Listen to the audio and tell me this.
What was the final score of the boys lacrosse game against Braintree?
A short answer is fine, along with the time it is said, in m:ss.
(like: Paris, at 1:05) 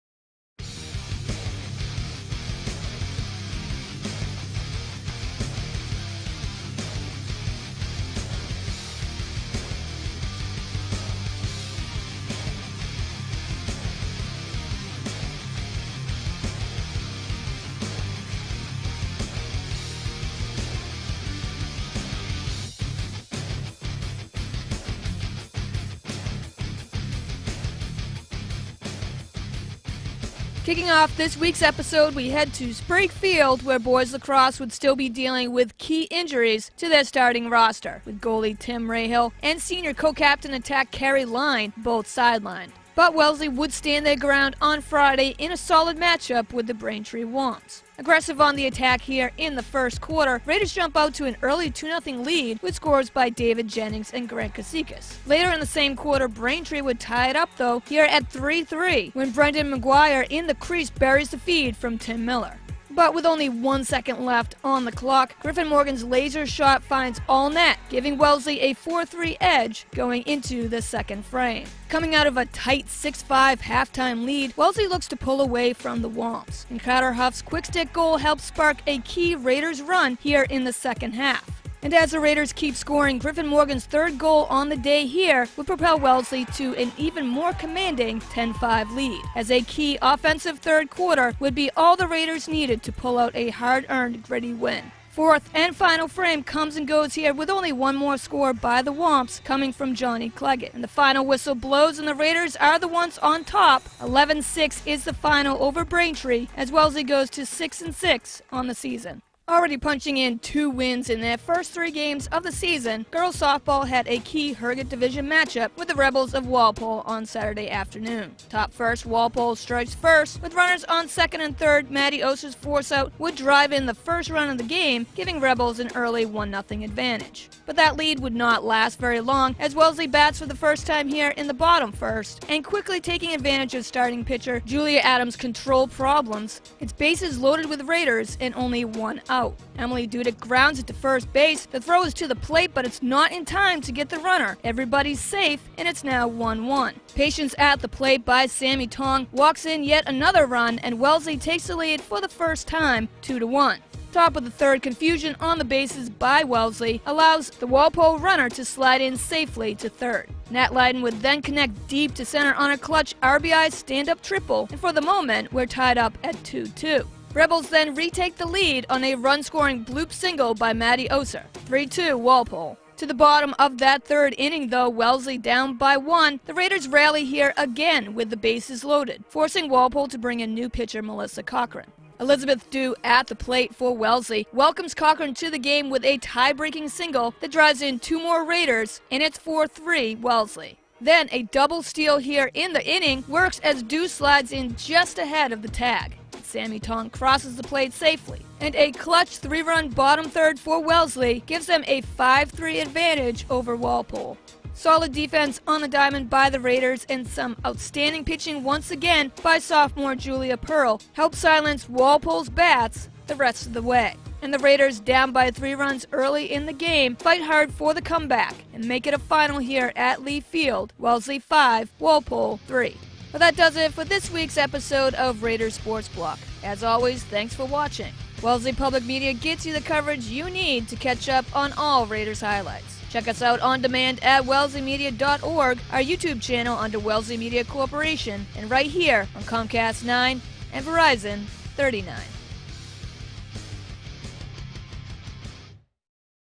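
11-6, at 1:43.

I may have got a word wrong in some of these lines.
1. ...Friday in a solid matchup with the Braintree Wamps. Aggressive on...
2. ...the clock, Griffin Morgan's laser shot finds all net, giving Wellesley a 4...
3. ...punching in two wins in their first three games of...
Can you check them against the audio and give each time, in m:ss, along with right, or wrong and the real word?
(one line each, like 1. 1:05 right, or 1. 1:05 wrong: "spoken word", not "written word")
1. 0:44 right
2. 1:04 right
3. 1:49 right.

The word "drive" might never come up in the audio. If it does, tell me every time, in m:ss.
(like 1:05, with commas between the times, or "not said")
2:03, 3:07.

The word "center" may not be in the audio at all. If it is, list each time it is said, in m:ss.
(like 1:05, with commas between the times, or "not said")
2:42.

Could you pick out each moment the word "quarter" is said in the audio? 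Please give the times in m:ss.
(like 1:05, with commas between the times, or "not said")
0:50, 0:55, 1:30.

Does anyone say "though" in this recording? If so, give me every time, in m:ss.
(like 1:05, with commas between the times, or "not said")
0:57, 2:54.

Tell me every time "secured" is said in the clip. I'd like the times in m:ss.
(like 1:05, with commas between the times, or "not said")
not said.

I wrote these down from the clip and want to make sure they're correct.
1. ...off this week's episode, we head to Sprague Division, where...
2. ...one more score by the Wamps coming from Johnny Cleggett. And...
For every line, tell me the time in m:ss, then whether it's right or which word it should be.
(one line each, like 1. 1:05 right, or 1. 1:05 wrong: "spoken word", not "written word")
1. 0:30 wrong: "Field", not "Division"
2. 1:37 right.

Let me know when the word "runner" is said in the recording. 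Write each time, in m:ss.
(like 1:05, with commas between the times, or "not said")
2:00, 2:24, 2:38.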